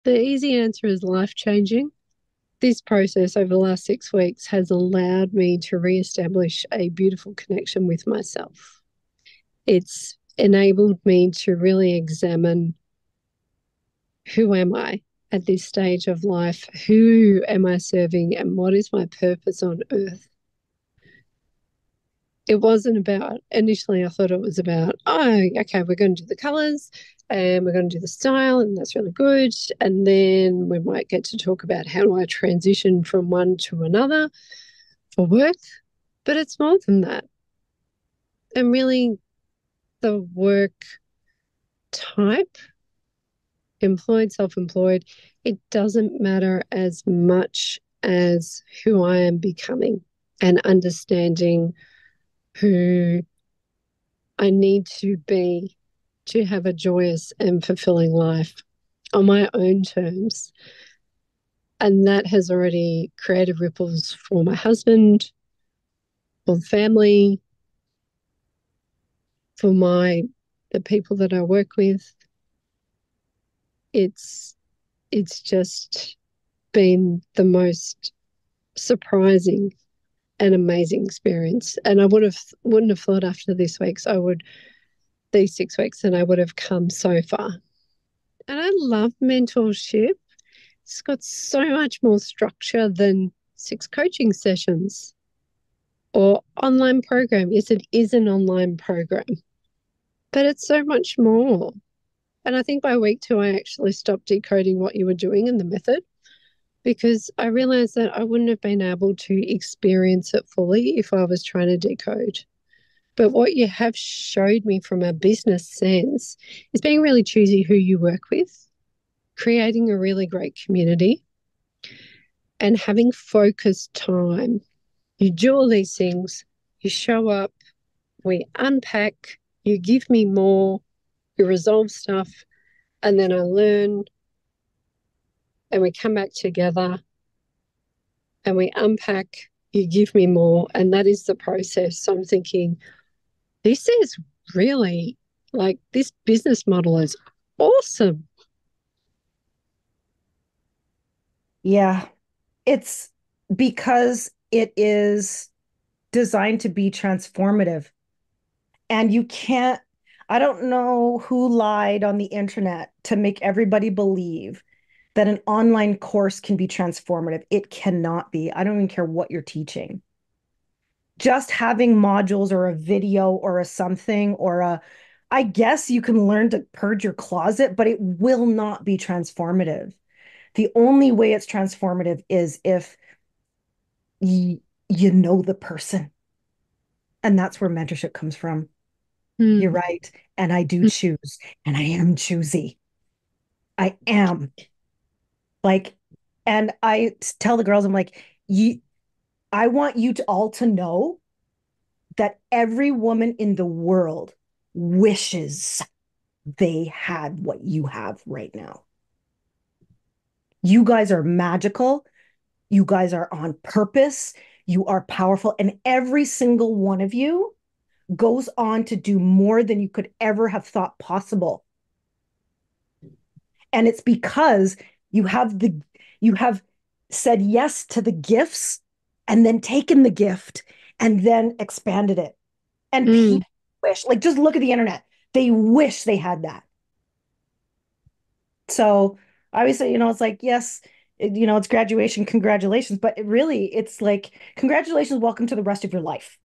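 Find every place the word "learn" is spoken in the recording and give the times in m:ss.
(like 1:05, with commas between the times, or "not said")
2:13, 2:56.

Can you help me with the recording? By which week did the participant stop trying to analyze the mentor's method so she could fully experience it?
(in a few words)
Week 2.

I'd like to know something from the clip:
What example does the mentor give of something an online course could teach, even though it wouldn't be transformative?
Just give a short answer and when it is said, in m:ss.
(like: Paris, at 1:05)
Purge your closet, at 2:56.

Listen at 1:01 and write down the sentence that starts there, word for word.
And that has already created ripples for my husband, for the family, for my the people that I work with.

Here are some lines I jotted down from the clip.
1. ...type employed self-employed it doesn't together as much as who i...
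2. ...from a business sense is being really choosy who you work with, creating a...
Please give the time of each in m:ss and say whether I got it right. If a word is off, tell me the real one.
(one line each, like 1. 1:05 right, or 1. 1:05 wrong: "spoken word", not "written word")
1. 0:41 wrong: "matter", not "together"
2. 1:54 right.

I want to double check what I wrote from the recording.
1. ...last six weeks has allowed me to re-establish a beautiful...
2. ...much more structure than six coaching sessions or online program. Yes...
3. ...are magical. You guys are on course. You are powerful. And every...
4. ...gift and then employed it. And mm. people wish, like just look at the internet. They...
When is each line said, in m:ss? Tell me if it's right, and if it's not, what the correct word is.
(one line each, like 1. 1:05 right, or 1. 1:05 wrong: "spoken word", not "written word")
1. 0:03 right
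2. 1:31 right
3. 3:31 wrong: "purpose", not "course"
4. 3:50 wrong: "expanded", not "employed".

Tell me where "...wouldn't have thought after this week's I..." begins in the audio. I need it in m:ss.
1:22.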